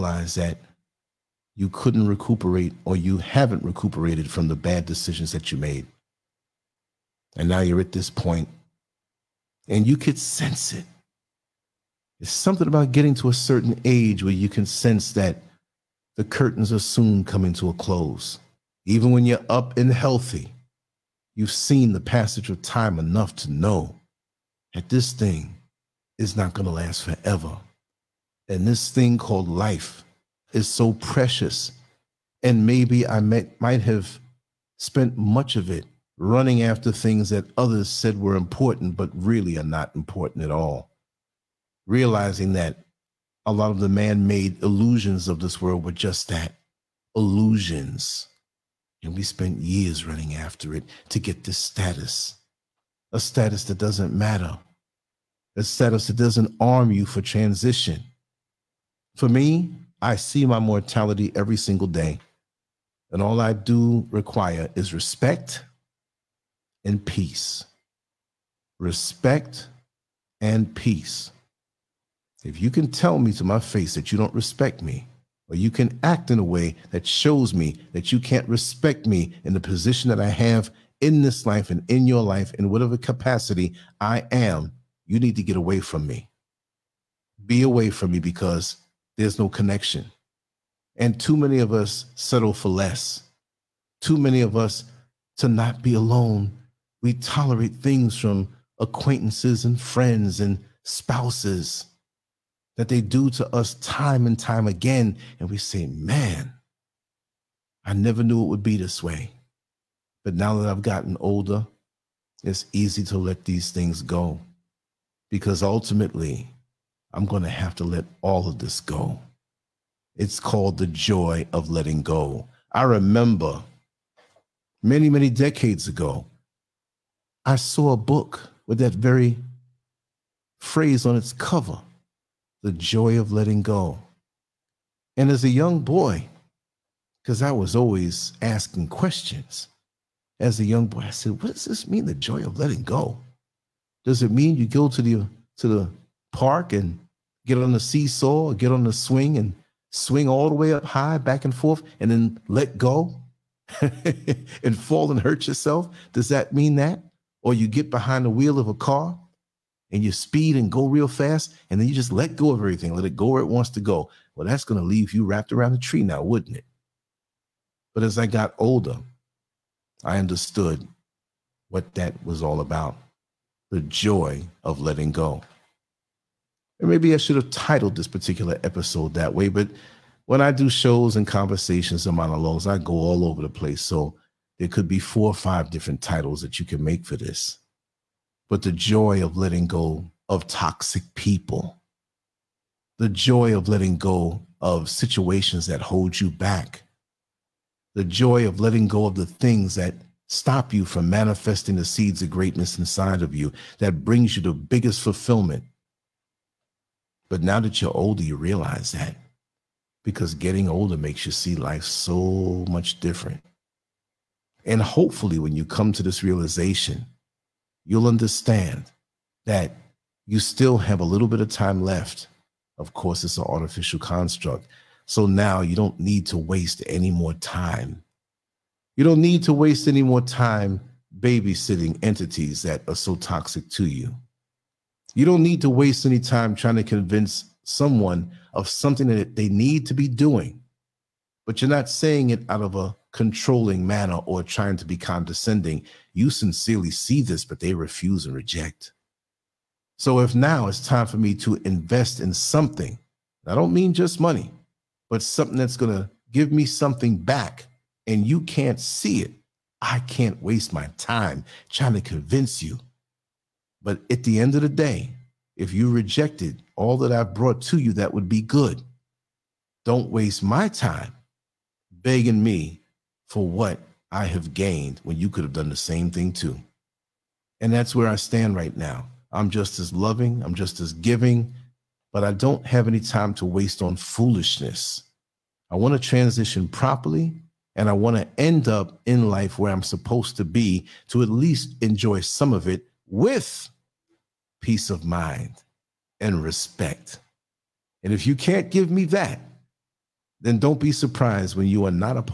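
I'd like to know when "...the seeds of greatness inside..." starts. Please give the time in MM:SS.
03:21.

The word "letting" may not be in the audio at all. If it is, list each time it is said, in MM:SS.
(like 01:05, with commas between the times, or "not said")
02:01, 02:13, 02:22, 02:54, 03:09, 03:13, 03:18.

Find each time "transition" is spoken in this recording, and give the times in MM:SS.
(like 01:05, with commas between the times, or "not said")
00:57, 04:46.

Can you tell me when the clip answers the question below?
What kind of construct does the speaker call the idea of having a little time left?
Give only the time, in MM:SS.
03:43.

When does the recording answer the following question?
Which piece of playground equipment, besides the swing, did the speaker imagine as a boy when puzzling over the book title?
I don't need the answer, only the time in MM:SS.
02:27.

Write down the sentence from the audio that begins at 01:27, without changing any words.
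Be away from me because there's no connection.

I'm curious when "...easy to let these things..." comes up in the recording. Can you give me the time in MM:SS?
01:52.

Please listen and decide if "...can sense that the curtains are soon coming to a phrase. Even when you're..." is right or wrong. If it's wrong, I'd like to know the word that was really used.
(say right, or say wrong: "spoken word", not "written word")
wrong: "close", not "phrase".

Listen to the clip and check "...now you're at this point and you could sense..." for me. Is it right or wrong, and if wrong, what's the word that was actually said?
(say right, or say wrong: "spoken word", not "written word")
right.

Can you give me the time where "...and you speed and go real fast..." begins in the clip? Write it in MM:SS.
02:39.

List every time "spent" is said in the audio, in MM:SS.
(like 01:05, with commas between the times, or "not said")
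00:34, 00:49.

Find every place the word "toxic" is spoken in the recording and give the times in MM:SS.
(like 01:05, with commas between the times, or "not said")
03:10, 03:53.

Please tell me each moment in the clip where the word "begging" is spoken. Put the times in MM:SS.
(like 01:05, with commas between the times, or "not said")
04:32.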